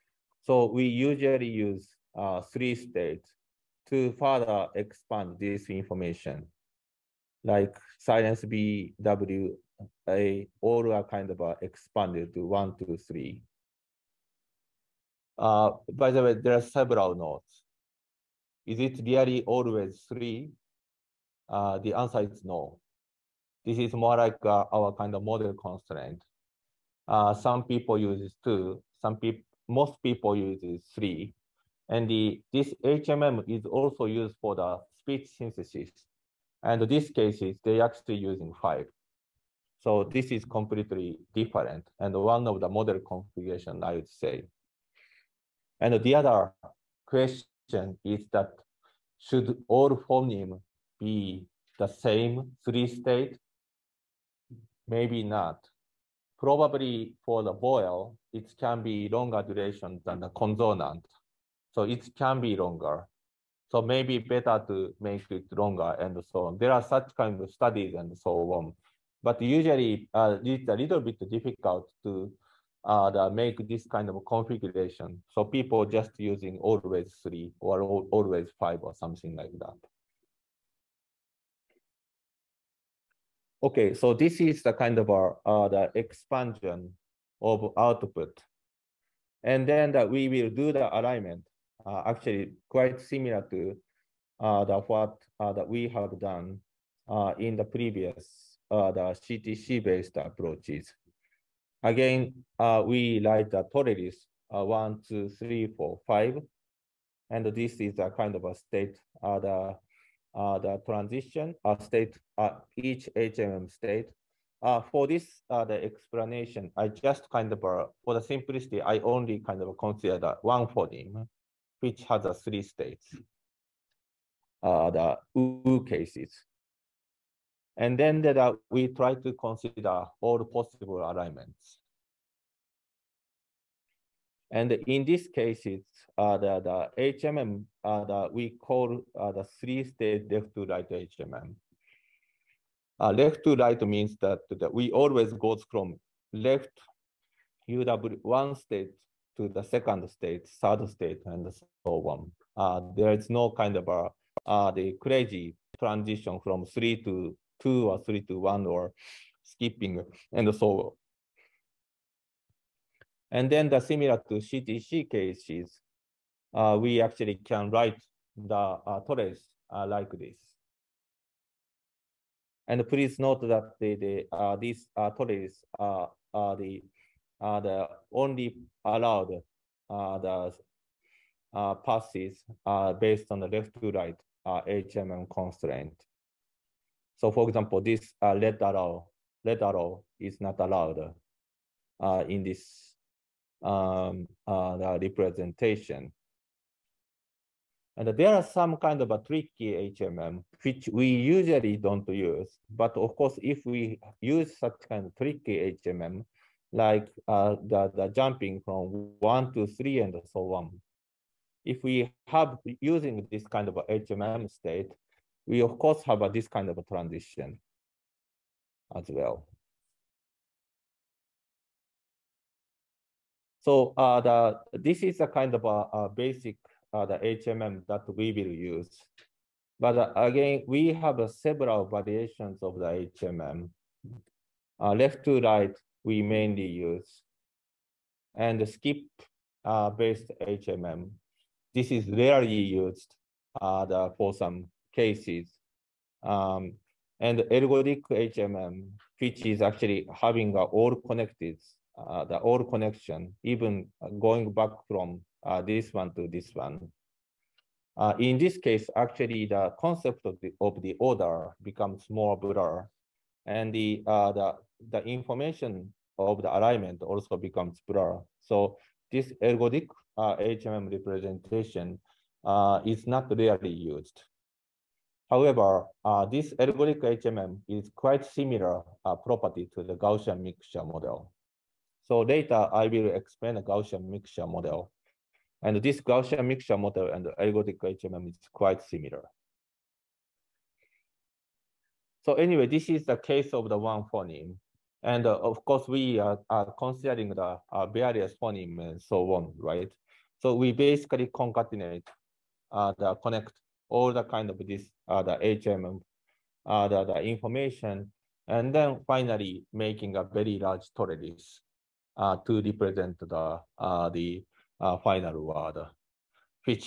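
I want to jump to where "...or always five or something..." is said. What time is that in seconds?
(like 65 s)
77 s.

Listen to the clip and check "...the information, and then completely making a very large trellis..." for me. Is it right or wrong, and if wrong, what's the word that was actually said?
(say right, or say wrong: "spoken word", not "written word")
wrong: "finally", not "completely".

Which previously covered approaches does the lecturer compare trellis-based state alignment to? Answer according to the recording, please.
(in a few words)
CTC-based approaches.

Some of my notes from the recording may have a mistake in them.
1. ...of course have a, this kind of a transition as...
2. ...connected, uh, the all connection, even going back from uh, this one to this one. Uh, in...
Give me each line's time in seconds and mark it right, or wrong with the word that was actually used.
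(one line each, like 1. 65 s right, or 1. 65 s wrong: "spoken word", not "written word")
1. 215 s right
2. 250 s right.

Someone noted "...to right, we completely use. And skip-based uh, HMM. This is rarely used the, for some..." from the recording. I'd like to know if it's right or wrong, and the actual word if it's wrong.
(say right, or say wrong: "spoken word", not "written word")
wrong: "mainly", not "completely".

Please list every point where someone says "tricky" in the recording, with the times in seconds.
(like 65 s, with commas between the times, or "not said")
199 s, 205 s.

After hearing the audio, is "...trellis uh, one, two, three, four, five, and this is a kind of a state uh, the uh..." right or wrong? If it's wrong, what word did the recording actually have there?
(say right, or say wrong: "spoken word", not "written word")
right.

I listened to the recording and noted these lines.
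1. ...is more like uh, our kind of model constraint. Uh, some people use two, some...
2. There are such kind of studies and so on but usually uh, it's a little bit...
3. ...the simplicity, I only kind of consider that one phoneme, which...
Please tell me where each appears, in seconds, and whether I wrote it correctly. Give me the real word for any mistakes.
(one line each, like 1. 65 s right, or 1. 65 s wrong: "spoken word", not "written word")
1. 23 s right
2. 66 s right
3. 118 s right.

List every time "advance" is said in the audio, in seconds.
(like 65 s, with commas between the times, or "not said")
not said.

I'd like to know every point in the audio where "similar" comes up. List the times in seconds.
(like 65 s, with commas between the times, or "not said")
92 s, 163 s, 278 s, 288 s.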